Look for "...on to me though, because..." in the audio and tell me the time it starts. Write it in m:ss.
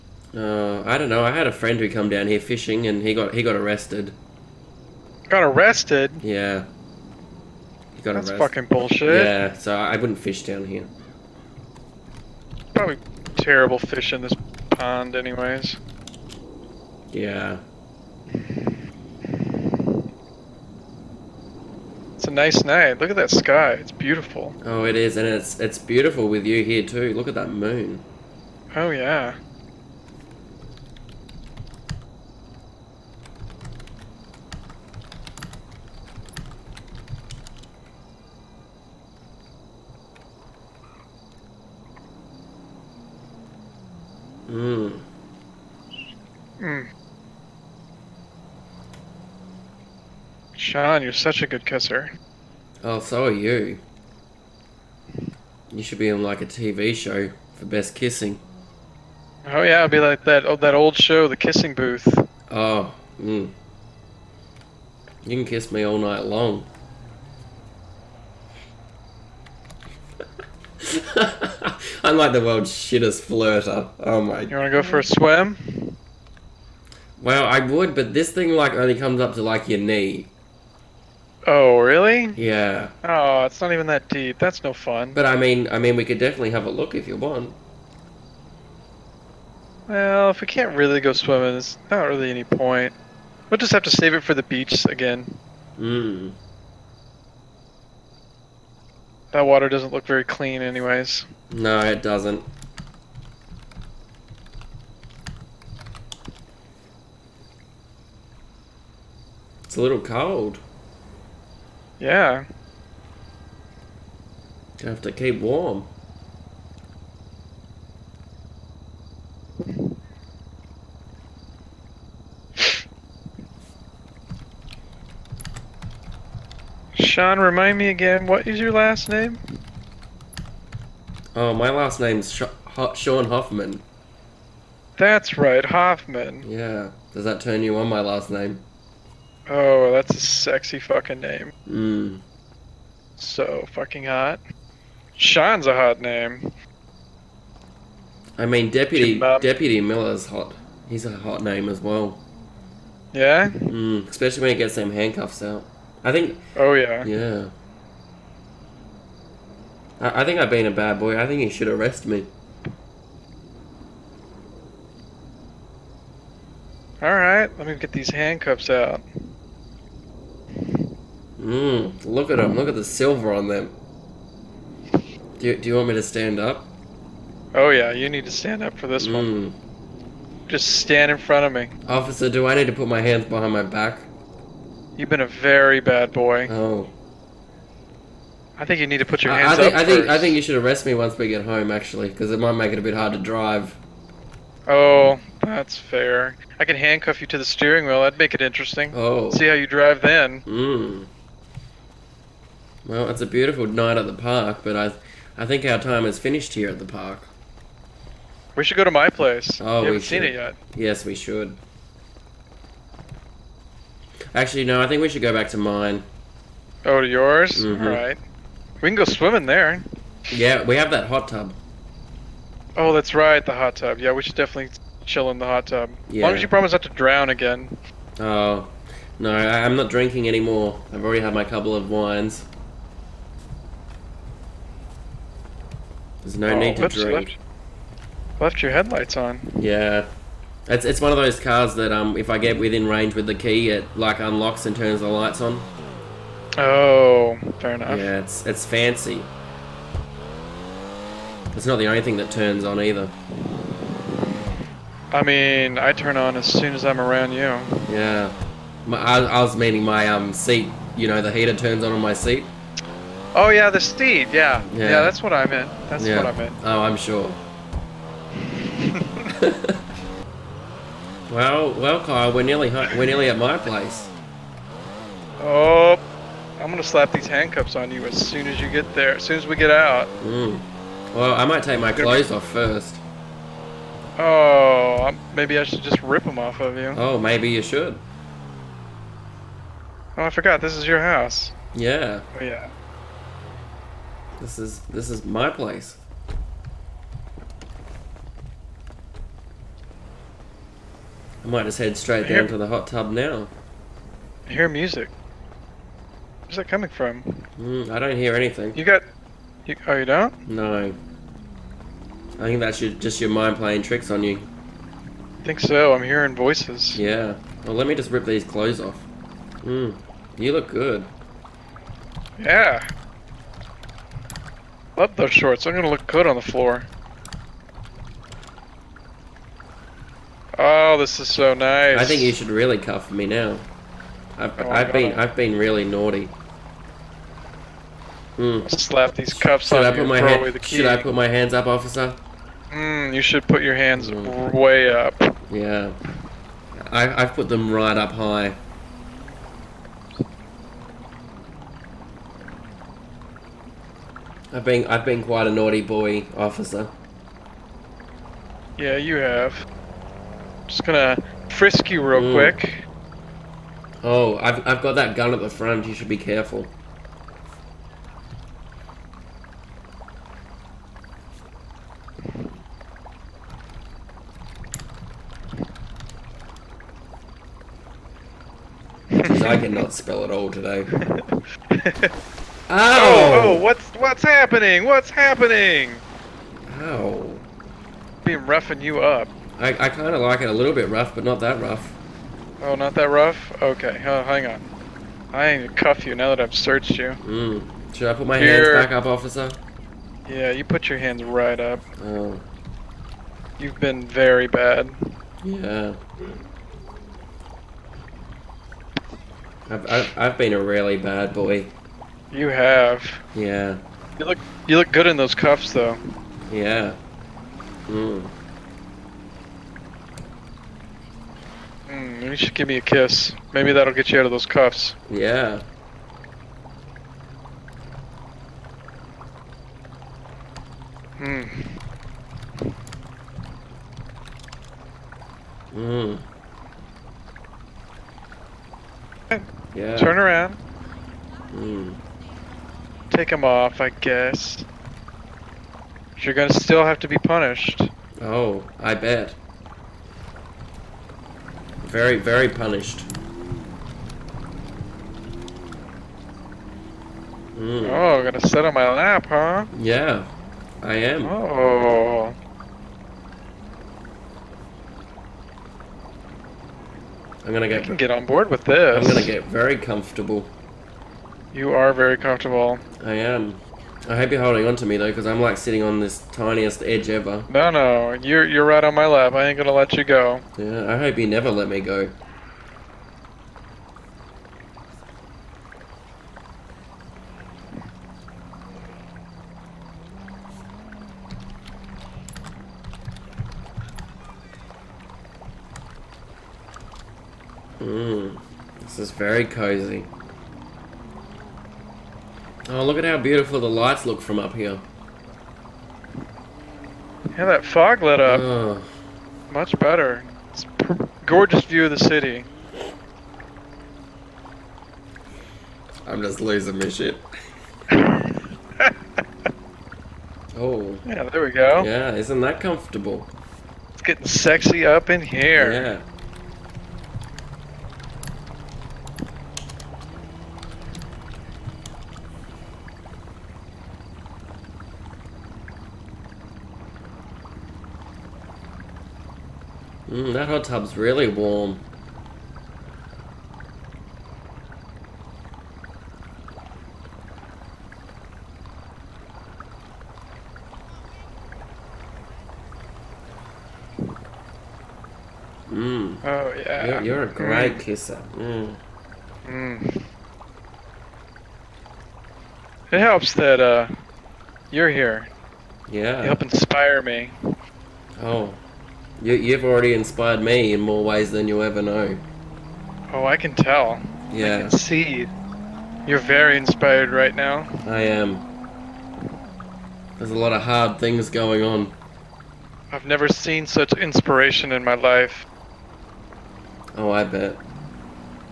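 7:54.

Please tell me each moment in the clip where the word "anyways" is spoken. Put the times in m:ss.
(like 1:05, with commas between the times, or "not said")
0:15, 1:40.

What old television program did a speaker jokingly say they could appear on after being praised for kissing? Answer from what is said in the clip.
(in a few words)
The Kissing Booth.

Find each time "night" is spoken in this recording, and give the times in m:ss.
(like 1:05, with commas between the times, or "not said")
0:22, 1:05, 3:23.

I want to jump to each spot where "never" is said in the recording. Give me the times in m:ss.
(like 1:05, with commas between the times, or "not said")
8:01, 9:43.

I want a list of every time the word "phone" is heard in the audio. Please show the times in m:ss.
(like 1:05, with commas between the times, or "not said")
not said.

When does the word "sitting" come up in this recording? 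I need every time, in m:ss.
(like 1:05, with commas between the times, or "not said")
7:55.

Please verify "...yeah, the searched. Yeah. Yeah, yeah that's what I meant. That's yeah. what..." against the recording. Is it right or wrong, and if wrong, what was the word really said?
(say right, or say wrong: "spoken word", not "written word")
wrong: "steed", not "searched".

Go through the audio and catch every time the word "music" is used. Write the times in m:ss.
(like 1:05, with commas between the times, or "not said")
5:04.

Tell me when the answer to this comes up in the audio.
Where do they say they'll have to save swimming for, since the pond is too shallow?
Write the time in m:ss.
1:34.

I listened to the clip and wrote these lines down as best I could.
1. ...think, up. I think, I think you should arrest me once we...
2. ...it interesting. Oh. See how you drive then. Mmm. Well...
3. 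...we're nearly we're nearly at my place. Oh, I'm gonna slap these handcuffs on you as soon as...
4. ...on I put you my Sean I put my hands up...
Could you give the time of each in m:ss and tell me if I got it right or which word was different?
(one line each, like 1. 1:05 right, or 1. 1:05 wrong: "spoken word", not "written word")
1. 3:09 right
2. 3:18 right
3. 4:32 right
4. 5:39 wrong: "Should", not "Sean".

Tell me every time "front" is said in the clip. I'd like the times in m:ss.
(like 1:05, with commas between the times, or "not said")
3:01, 6:05.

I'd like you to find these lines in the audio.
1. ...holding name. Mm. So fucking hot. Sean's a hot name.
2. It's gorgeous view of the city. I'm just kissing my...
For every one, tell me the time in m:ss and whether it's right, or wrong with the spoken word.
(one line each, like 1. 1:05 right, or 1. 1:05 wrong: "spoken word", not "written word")
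1. 2:20 wrong: "fucking", not "holding"
2. 8:30 wrong: "losing", not "kissing".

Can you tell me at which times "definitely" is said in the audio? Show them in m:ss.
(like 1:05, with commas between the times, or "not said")
1:26, 3:44.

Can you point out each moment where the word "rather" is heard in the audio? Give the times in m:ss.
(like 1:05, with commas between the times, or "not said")
not said.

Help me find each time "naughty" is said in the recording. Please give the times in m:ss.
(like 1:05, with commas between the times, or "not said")
5:35, 5:55.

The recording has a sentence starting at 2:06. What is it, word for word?
Sean, remind me again, what is your last name?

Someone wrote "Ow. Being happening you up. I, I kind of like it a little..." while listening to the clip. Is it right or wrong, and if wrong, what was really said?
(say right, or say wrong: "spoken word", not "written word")
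wrong: "roughing", not "happening".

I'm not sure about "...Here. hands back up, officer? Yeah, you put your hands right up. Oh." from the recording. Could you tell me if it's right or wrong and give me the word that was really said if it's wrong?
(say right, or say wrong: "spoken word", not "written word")
right.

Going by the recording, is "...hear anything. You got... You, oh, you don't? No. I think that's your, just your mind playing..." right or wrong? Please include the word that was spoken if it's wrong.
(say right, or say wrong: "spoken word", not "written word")
right.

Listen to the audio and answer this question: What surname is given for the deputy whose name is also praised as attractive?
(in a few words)
Miller.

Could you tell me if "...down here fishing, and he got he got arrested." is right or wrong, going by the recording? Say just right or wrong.
right.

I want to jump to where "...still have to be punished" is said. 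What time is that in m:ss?
7:26.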